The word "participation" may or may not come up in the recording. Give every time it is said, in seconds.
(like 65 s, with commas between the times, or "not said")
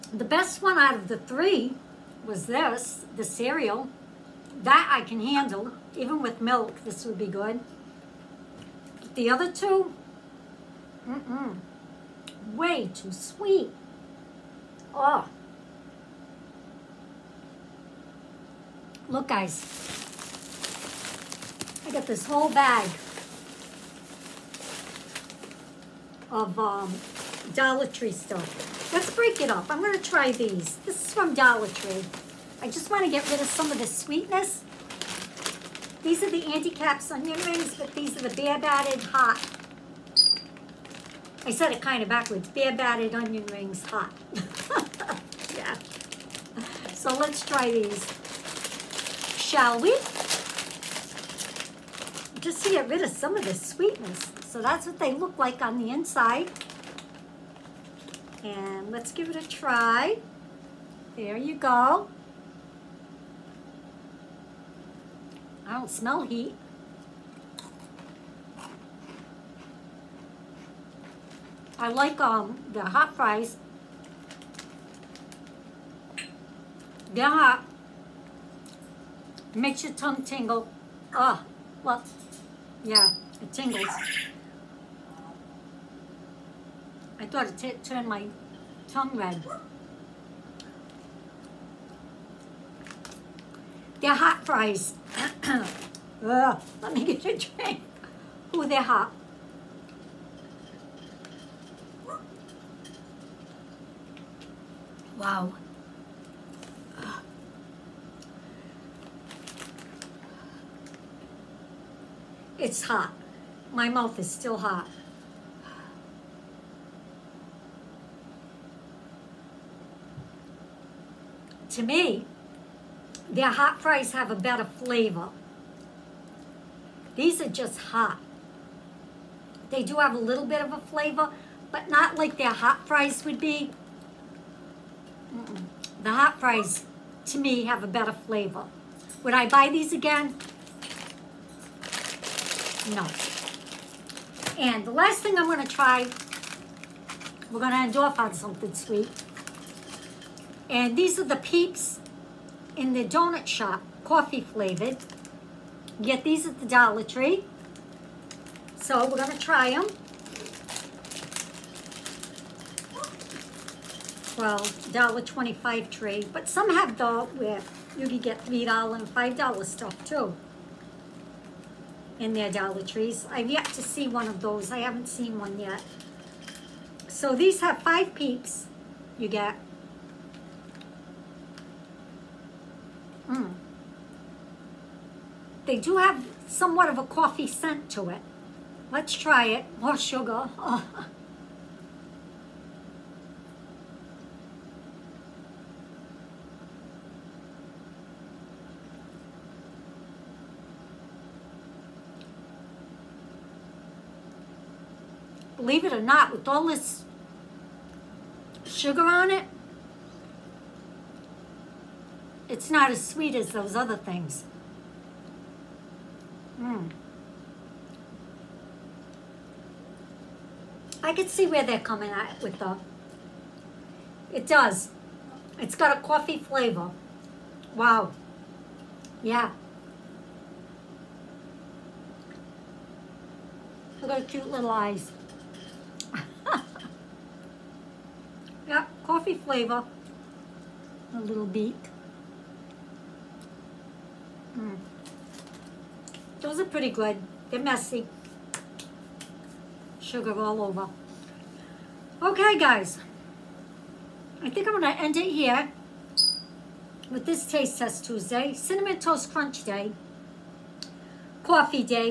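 not said.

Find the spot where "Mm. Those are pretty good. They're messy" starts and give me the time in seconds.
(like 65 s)
244 s.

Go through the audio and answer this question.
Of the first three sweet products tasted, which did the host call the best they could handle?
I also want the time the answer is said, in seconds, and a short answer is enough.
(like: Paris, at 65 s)
The cereal, at 3 s.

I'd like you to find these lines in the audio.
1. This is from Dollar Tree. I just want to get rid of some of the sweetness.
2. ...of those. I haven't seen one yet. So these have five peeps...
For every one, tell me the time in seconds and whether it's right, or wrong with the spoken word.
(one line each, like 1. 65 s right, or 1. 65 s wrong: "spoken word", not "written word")
1. 30 s right
2. 174 s right.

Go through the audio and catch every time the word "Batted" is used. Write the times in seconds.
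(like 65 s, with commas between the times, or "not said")
38 s, 42 s.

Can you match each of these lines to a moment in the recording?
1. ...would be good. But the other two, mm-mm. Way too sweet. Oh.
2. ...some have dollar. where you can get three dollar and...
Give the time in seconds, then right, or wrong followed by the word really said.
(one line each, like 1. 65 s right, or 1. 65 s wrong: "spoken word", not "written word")
1. 7 s right
2. 166 s right.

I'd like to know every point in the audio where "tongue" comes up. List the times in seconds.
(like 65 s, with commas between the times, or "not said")
79 s, 88 s.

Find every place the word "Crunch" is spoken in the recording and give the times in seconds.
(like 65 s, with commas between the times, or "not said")
259 s.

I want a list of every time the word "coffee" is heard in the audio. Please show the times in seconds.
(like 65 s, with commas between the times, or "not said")
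154 s, 187 s, 226 s, 239 s, 261 s.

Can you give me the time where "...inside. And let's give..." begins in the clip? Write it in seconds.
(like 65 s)
55 s.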